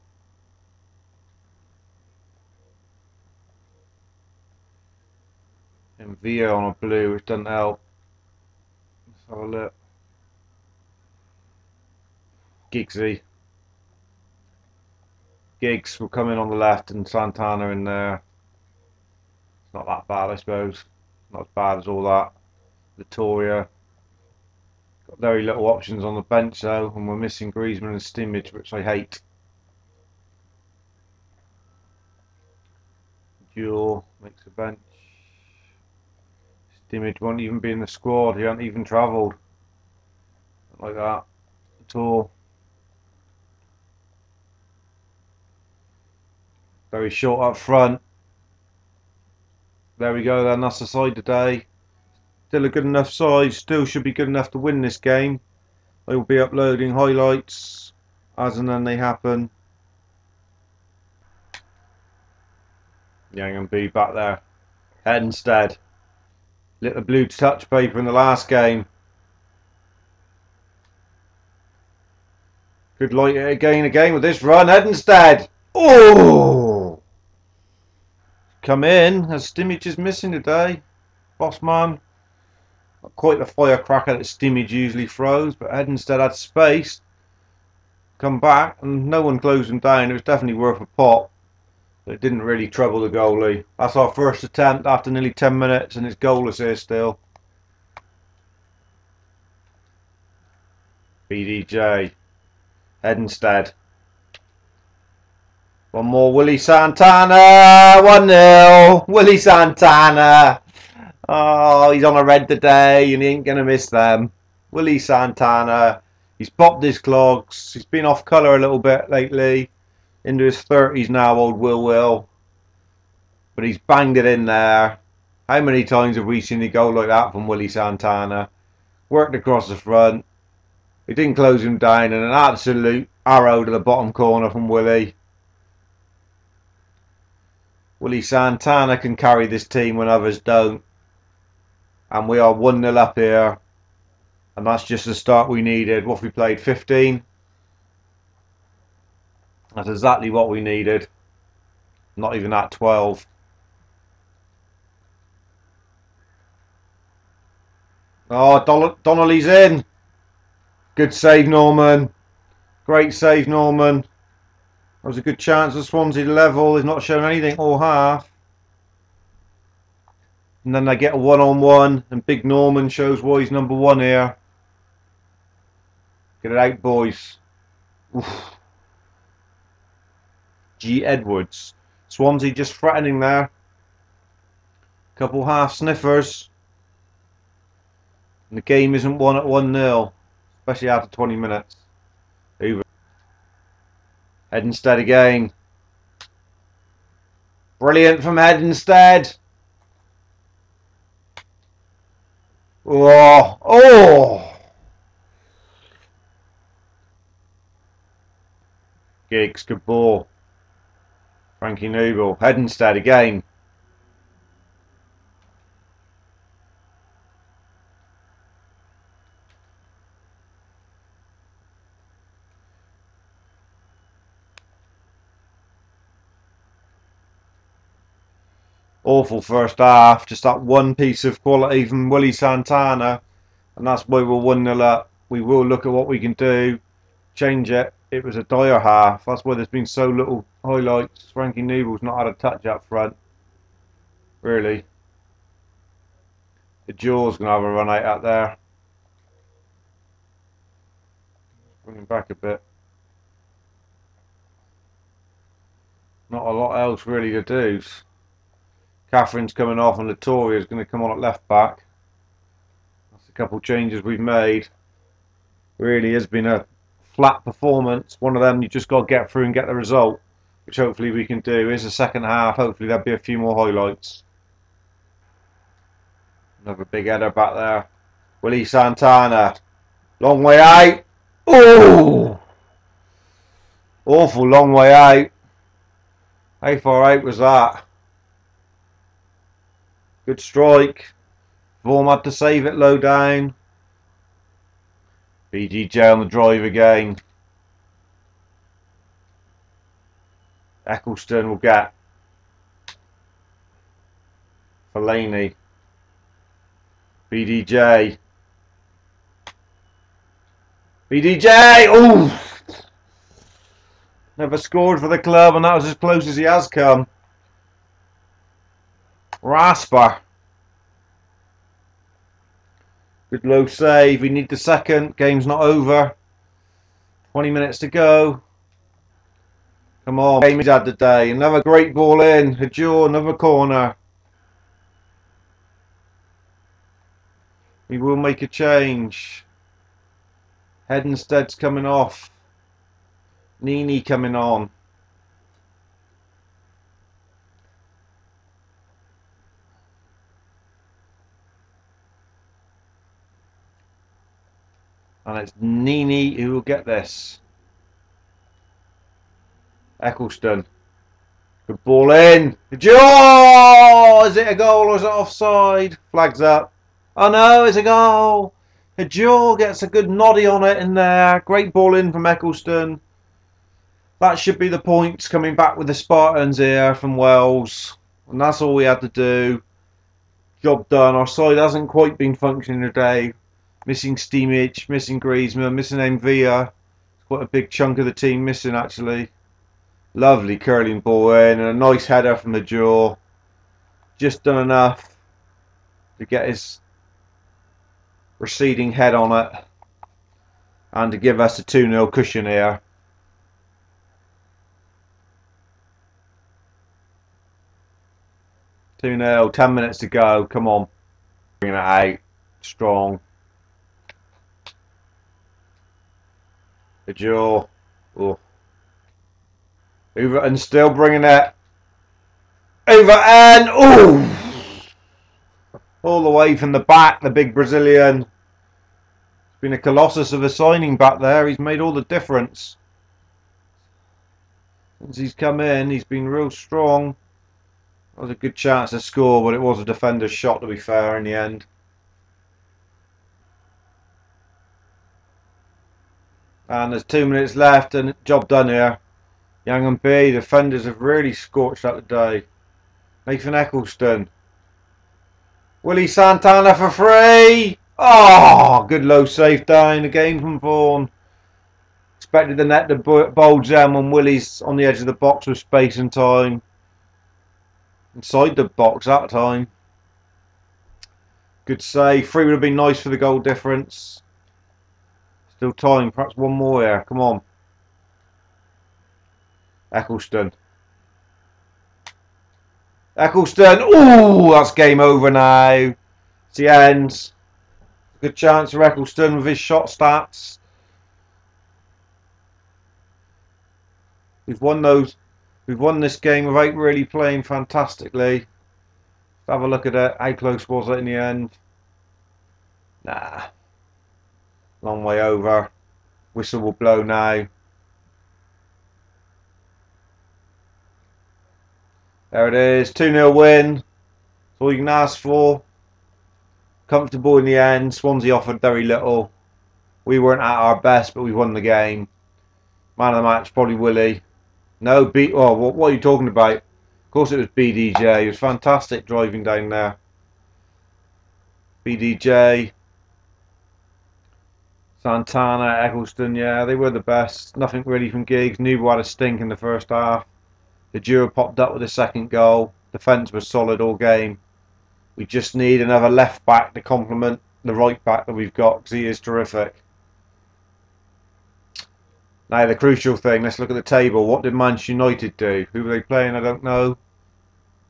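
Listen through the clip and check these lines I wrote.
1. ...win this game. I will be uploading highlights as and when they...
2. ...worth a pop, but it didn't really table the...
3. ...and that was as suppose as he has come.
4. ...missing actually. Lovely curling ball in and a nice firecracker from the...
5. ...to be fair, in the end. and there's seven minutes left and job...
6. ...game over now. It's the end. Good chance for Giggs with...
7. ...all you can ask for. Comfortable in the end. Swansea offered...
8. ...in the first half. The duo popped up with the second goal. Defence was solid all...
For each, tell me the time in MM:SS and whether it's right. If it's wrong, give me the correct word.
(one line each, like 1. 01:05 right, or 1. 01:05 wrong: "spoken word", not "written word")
1. 00:54 right
2. 01:30 wrong: "trouble", not "table"
3. 05:15 wrong: "close", not "suppose"
4. 06:28 wrong: "header", not "firecracker"
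5. 07:20 wrong: "two", not "seven"
6. 08:04 wrong: "Eccleston", not "Giggs"
7. 08:34 right
8. 08:59 right.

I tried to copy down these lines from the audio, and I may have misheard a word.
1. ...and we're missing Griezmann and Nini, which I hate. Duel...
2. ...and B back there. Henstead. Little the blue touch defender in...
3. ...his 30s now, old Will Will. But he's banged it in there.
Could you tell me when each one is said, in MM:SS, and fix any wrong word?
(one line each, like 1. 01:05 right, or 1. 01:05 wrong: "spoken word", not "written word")
1. 00:26 wrong: "Stimage", not "Nini"
2. 01:03 wrong: "paper", not "defender"
3. 02:00 right.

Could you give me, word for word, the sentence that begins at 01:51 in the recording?
Oh, he's on a red today and he ain't going to miss them.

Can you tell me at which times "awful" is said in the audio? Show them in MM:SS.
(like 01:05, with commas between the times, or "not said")
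03:49, 04:44.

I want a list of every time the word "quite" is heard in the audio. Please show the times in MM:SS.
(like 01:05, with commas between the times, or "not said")
01:23, 06:21, 06:27.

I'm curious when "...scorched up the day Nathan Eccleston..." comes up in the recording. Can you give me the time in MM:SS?
07:31.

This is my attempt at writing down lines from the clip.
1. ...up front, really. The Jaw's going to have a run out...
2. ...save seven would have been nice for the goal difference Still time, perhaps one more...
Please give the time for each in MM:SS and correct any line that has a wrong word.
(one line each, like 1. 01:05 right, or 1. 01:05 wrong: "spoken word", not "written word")
1. 04:02 right
2. 07:51 wrong: "three", not "seven".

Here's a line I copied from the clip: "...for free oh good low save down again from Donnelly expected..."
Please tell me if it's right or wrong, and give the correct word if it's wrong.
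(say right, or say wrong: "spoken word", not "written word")
wrong: "Vorm", not "Donnelly".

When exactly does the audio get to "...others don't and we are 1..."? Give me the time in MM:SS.
02:20.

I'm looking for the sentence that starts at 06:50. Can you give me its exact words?
Come on, bringing it out strong.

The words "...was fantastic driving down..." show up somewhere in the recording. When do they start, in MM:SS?
08:48.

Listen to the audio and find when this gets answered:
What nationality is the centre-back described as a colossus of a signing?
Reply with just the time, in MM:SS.
07:07.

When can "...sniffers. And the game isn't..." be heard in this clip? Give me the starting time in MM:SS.
03:05.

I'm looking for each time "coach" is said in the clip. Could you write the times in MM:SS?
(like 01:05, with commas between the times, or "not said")
not said.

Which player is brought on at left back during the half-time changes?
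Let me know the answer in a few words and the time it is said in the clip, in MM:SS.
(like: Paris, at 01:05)
Latoria, at 04:20.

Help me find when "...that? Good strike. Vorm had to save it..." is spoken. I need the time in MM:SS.
04:47.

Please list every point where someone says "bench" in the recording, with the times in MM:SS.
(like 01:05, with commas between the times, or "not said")
00:26, 00:34.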